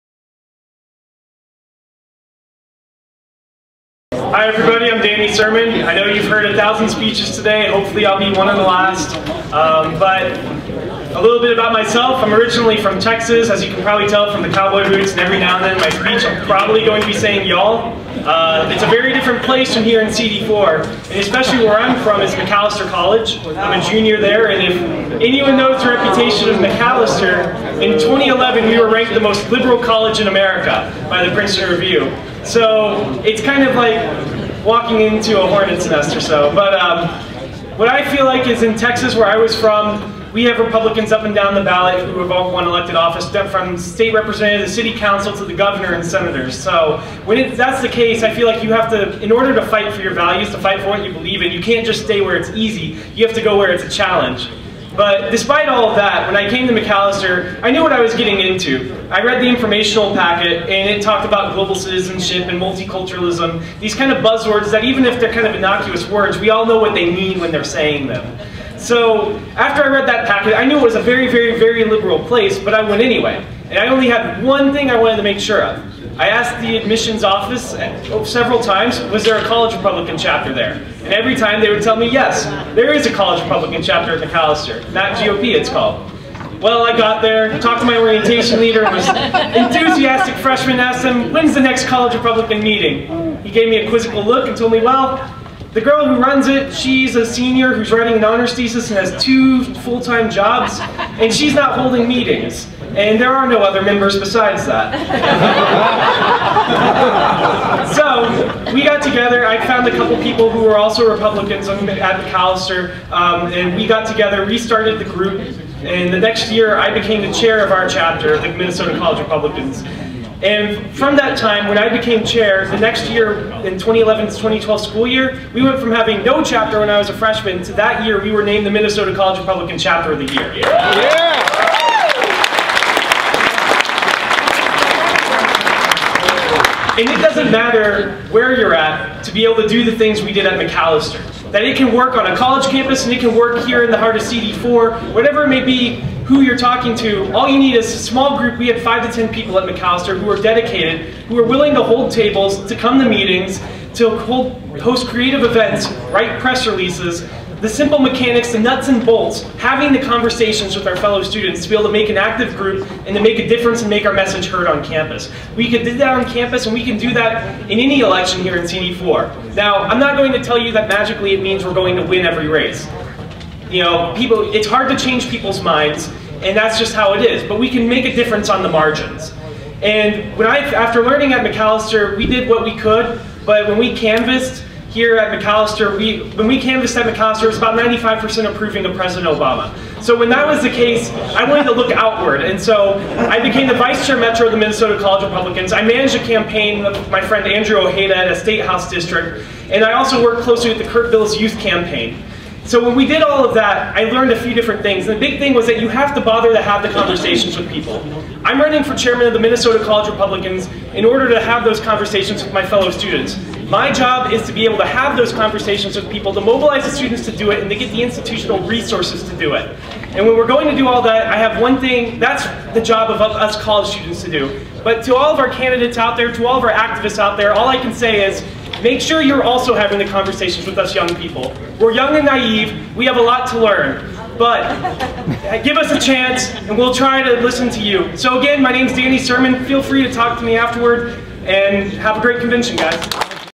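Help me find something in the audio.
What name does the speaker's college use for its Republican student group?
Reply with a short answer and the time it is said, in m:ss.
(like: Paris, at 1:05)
not GOP, at 1:24.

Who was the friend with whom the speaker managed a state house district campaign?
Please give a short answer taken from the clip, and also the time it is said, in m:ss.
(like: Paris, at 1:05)
Andrew Ojeda, at 3:17.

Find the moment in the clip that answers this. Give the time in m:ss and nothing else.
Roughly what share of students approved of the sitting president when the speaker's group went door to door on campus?
3:07.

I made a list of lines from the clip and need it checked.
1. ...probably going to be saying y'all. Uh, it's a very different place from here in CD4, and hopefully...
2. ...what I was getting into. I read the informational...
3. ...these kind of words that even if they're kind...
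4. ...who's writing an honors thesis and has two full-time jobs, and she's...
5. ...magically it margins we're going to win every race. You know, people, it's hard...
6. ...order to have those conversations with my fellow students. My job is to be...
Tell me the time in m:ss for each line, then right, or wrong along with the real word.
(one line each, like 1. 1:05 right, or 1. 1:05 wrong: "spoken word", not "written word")
1. 0:16 wrong: "especially", not "hopefully"
2. 0:57 right
3. 1:03 wrong: "buzzwords", not "words"
4. 1:37 right
5. 2:50 wrong: "means", not "margins"
6. 3:31 right.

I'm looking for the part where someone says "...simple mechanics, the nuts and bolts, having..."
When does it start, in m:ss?
2:37.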